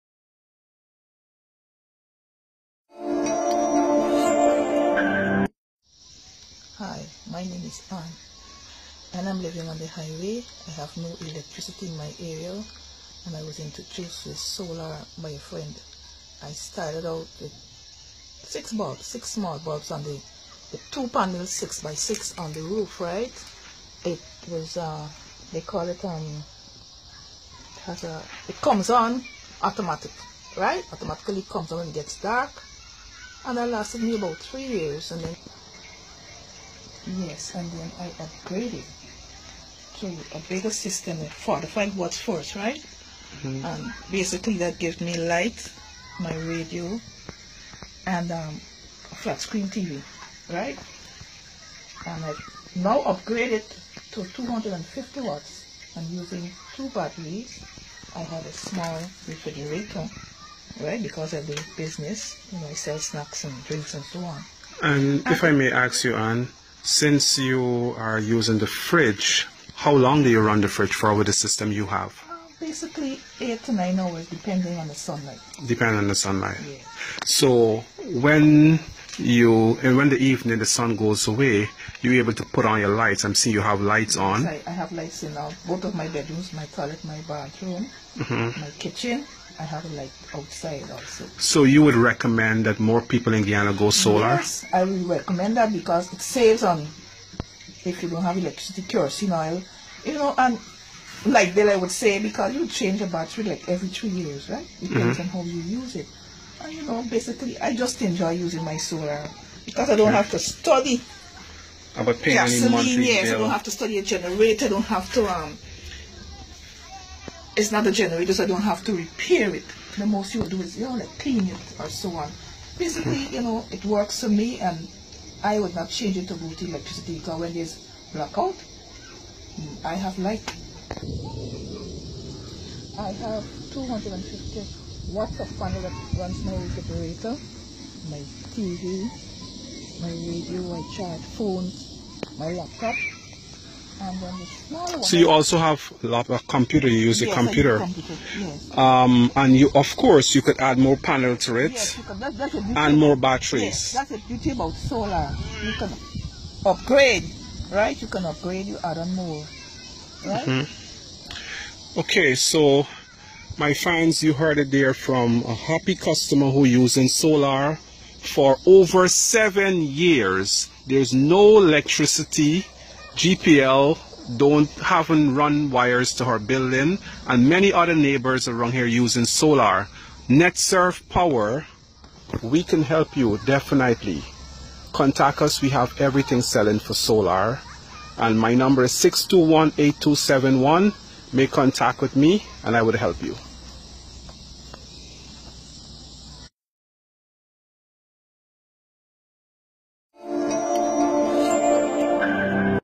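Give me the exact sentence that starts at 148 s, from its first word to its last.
Um, and you, of course, you could add more panels to it yes, that's, that's a and more batteries.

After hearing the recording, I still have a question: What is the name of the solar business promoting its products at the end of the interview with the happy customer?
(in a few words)
NetSurf Power.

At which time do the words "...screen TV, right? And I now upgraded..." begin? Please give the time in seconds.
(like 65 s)
49 s.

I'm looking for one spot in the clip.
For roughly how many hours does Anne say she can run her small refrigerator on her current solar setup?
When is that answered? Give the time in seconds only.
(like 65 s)
73 s.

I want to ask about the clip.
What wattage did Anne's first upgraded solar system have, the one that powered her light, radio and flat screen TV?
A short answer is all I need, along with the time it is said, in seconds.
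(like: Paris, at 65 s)
45 watts, at 41 s.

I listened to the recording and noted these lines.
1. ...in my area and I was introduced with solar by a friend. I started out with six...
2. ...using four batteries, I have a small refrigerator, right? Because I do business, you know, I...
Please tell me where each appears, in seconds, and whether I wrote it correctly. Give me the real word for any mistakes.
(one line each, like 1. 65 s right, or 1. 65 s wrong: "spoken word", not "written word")
1. 11 s right
2. 56 s wrong: "two", not "four".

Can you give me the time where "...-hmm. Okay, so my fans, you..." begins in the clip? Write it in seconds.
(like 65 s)
160 s.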